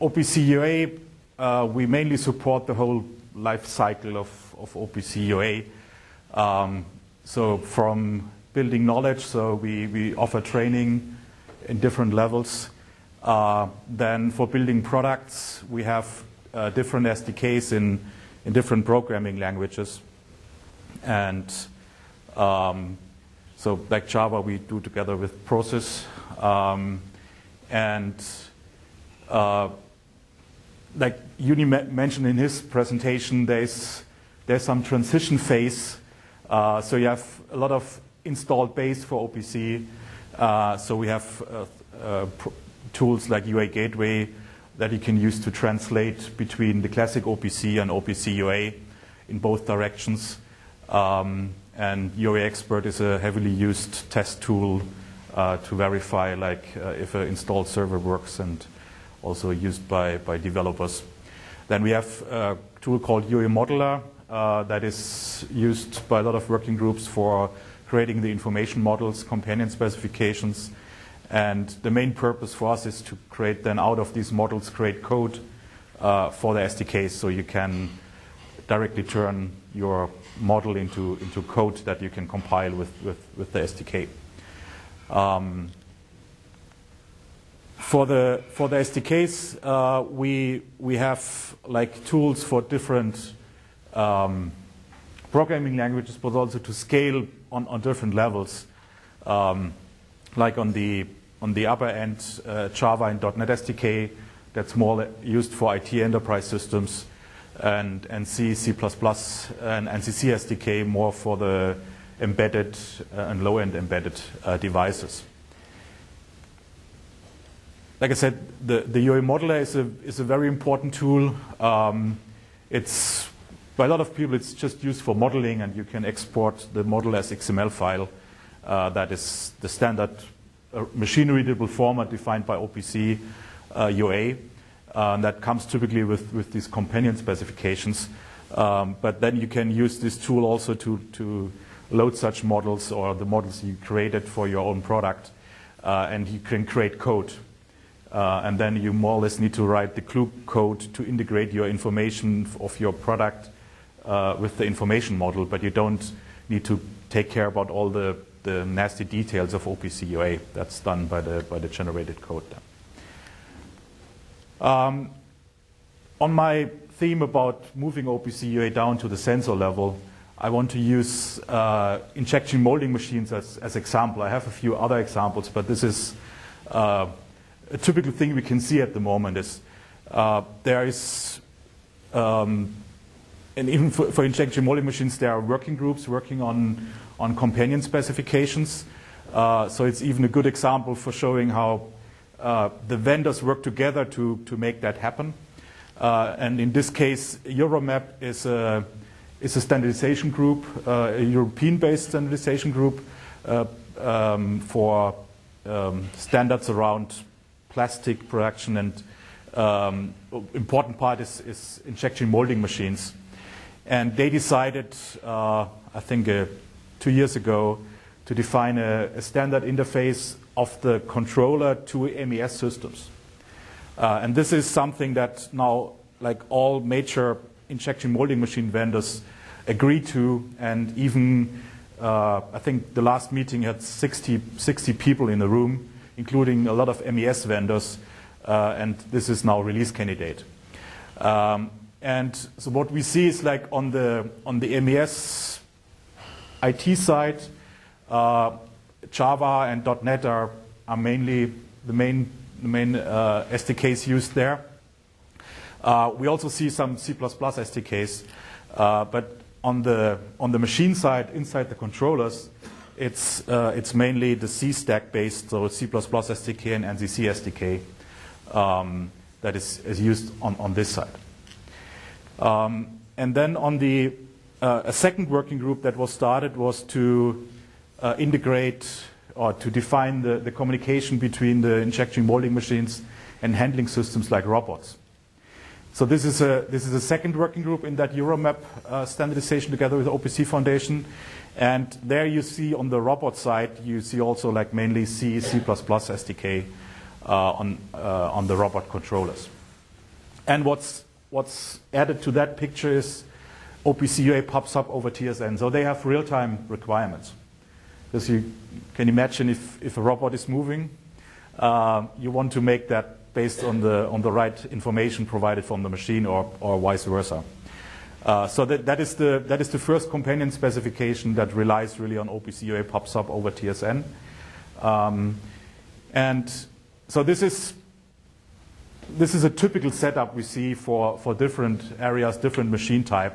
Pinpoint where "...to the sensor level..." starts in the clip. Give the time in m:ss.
2:48.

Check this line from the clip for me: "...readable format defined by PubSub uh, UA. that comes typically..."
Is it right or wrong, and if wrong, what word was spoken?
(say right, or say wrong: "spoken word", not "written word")
wrong: "OPC", not "PubSub".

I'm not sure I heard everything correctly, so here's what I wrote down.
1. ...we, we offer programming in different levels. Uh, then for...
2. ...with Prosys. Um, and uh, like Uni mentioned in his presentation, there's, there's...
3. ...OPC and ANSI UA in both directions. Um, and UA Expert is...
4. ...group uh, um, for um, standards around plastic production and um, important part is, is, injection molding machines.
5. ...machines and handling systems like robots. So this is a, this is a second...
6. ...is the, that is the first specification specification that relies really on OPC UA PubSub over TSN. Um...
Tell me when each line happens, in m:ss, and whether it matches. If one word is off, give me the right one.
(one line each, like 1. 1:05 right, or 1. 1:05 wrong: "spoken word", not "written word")
1. 0:09 wrong: "training", not "programming"
2. 0:25 right
3. 0:47 wrong: "OPC", not "ANSI"
4. 3:22 right
5. 4:42 right
6. 5:18 wrong: "companion", not "specification".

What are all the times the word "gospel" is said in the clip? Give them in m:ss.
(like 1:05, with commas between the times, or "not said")
not said.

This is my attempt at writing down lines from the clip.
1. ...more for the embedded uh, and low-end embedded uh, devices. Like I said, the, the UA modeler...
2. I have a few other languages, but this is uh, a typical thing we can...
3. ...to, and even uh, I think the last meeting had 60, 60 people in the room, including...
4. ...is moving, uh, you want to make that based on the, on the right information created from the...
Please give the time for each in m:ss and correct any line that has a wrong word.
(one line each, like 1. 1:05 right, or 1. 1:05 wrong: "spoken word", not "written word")
1. 1:50 right
2. 2:54 wrong: "examples", not "languages"
3. 3:50 right
4. 5:10 wrong: "provided", not "created".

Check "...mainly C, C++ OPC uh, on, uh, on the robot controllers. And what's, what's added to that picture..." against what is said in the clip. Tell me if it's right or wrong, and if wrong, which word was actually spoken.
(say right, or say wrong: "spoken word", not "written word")
wrong: "SDK", not "OPC".